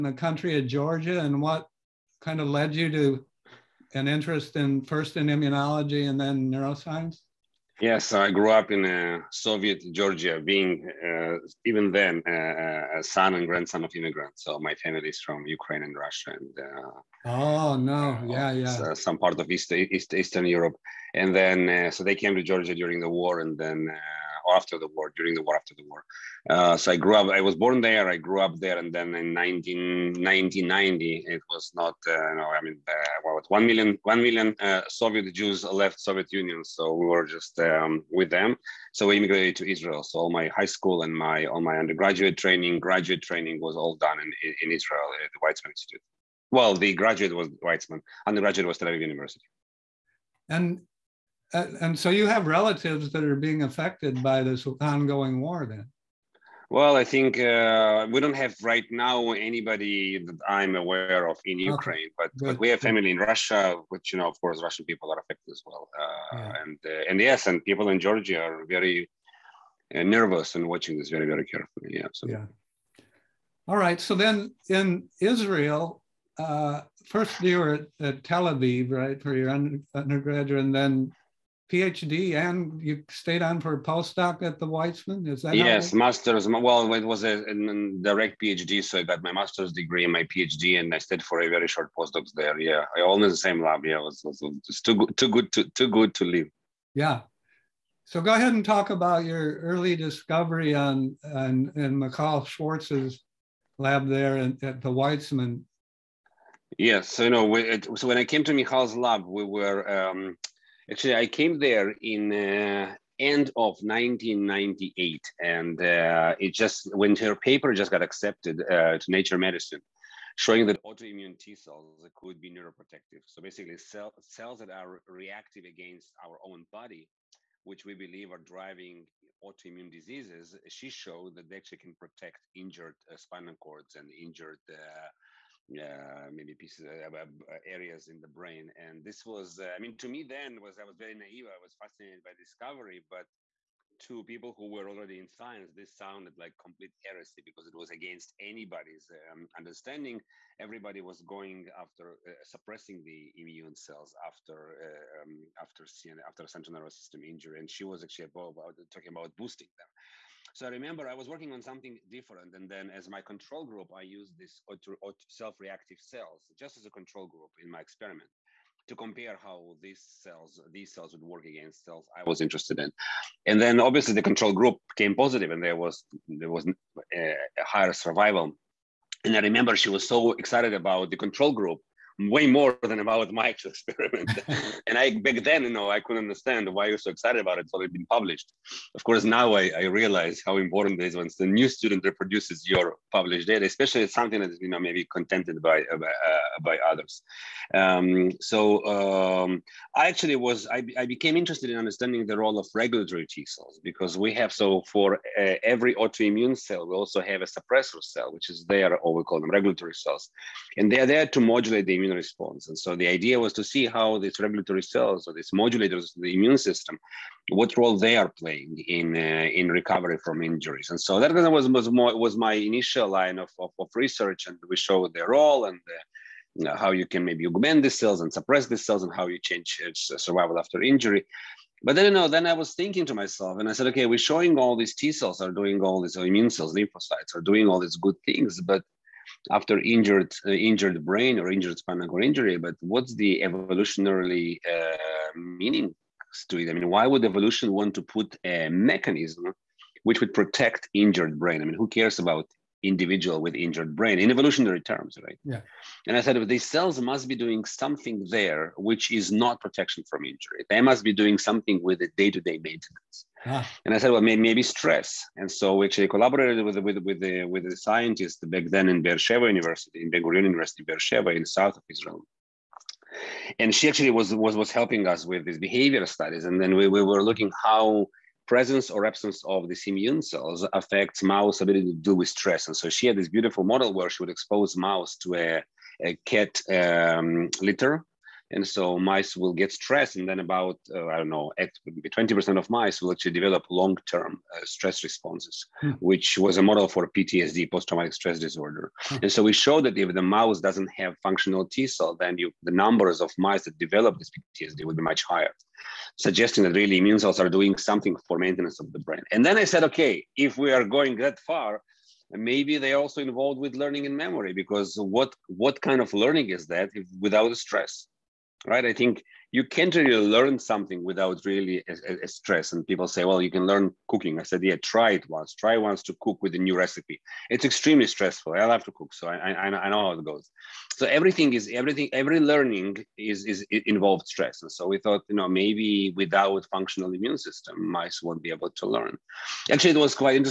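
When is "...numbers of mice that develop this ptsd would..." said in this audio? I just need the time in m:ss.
5:02.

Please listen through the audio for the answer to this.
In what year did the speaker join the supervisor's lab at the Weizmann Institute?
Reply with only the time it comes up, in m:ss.
1:53.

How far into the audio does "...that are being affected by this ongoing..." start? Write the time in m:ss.
0:53.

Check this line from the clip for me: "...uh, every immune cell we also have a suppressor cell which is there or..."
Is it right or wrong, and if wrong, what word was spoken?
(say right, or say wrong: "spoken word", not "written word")
wrong: "autoimmune", not "immune".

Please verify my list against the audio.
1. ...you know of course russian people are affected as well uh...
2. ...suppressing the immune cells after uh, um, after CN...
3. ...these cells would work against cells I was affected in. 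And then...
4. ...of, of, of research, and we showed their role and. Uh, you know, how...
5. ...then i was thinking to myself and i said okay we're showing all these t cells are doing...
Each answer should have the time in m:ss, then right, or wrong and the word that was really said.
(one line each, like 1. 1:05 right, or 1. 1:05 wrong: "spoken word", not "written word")
1. 1:04 right
2. 2:32 right
3. 2:50 wrong: "interested", not "affected"
4. 3:43 right
5. 3:52 right.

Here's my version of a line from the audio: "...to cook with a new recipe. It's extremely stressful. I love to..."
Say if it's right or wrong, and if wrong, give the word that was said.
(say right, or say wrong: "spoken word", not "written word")
right.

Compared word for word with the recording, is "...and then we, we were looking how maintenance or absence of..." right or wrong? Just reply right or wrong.
wrong.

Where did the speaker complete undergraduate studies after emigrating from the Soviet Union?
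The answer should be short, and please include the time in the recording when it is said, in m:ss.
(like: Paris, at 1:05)
Tel Aviv University, at 0:48.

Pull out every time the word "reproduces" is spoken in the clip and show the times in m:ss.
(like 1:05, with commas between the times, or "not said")
3:12.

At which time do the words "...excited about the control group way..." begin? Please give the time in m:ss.
3:00.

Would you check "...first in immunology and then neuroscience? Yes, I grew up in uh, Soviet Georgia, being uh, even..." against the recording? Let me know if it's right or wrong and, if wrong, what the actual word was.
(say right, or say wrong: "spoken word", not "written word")
right.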